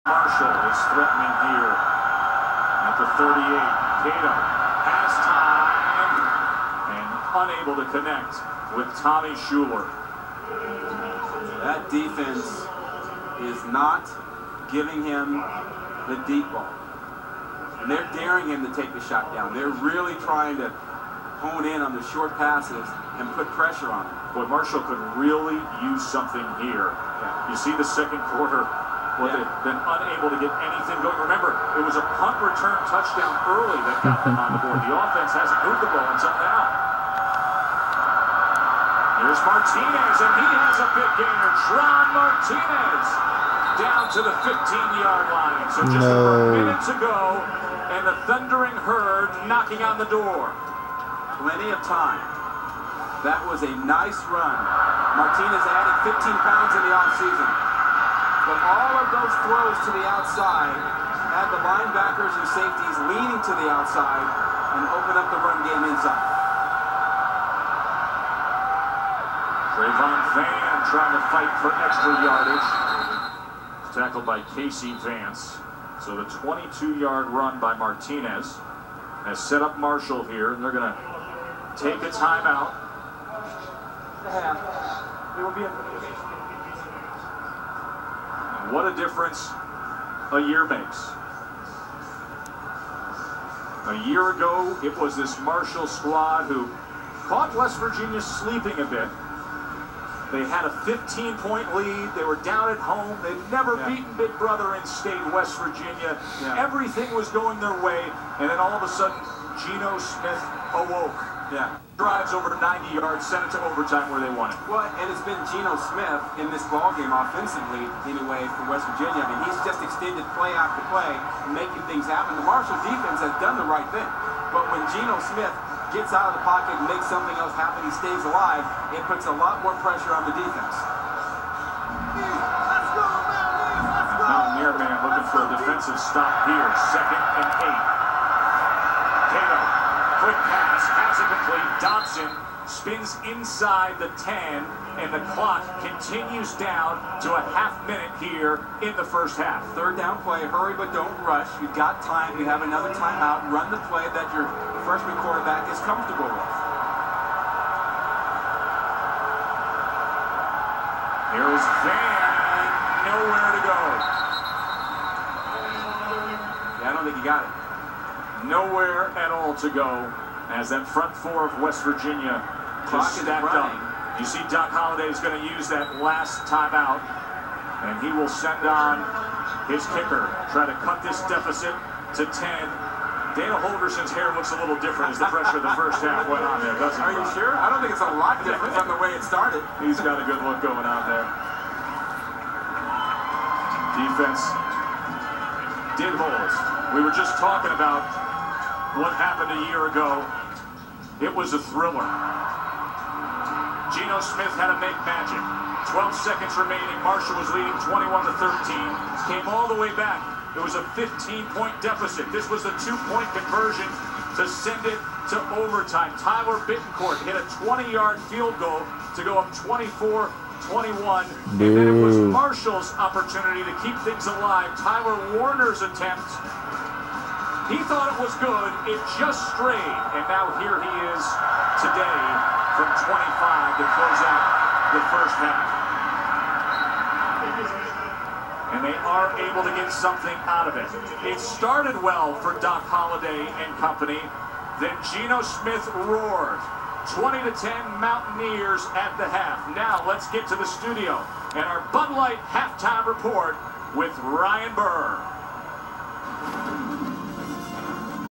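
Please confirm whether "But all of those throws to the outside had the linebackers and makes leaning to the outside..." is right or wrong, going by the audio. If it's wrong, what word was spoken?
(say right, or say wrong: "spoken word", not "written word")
wrong: "safeties", not "makes".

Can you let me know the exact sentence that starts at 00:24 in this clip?
Boy, Marshall could really use something here.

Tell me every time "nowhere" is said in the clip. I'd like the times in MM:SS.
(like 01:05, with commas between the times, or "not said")
02:43, 02:48.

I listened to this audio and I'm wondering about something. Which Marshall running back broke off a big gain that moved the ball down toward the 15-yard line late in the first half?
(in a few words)
Tron Martinez.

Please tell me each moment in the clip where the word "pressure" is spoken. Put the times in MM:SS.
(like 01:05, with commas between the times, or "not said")
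00:23, 02:09, 03:05.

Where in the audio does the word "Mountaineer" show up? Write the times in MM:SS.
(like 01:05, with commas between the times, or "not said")
02:14, 04:08.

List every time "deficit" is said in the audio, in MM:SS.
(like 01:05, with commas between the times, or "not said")
03:01, 03:31.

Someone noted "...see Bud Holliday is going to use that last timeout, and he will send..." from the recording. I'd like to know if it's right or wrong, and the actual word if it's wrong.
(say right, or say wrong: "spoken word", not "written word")
wrong: "Doc", not "Bud".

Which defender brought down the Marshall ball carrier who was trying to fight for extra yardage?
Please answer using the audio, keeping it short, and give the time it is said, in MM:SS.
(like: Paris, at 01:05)
Casey Vance, at 01:14.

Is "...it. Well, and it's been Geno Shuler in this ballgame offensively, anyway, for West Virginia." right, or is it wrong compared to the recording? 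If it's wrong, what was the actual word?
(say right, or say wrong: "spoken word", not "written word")
wrong: "Smith", not "Shuler".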